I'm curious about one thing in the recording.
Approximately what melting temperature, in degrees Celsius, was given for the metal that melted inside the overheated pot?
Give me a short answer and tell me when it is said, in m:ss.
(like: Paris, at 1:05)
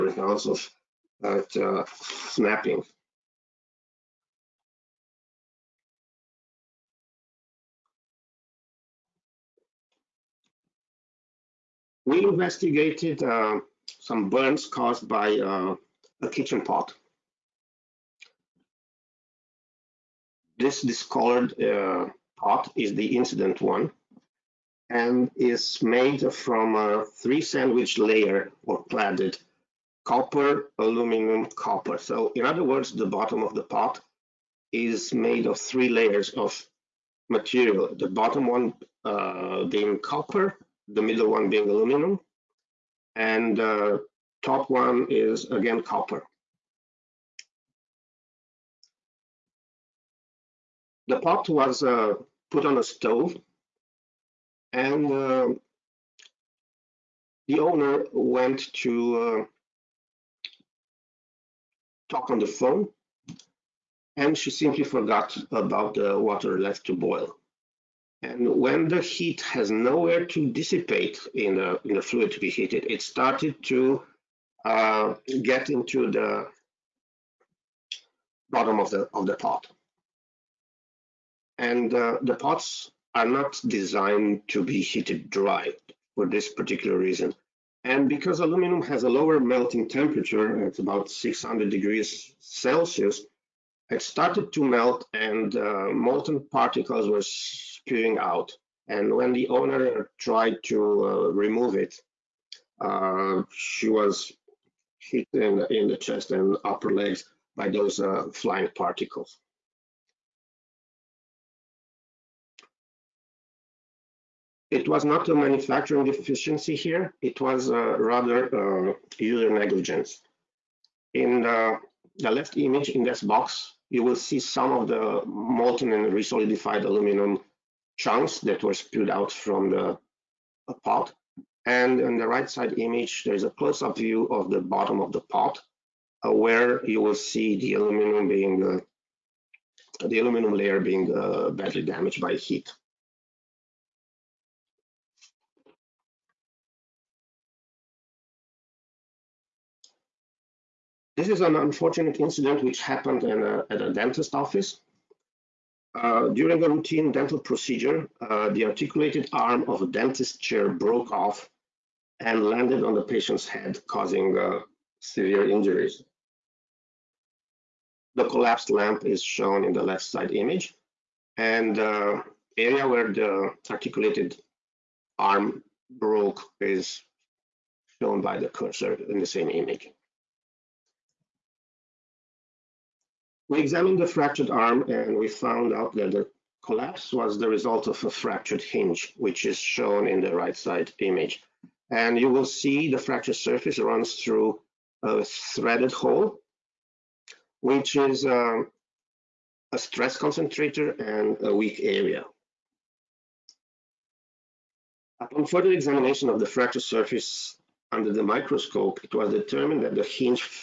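600, at 1:31.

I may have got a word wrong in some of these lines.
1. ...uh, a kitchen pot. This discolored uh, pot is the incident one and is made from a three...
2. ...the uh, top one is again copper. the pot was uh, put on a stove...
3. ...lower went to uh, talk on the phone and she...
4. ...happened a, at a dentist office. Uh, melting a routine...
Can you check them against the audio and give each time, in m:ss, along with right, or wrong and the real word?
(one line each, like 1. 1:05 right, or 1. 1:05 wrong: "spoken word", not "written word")
1. 0:15 right
2. 0:43 right
3. 0:57 wrong: "owner", not "lower"
4. 2:32 wrong: "during", not "melting".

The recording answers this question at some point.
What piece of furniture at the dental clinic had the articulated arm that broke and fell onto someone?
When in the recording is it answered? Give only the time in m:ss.
2:39.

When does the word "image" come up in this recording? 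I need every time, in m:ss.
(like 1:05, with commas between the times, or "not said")
2:02, 2:12, 2:50, 2:59, 3:10.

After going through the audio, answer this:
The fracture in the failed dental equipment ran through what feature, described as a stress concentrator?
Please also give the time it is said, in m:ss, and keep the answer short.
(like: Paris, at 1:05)
threaded hole, at 3:15.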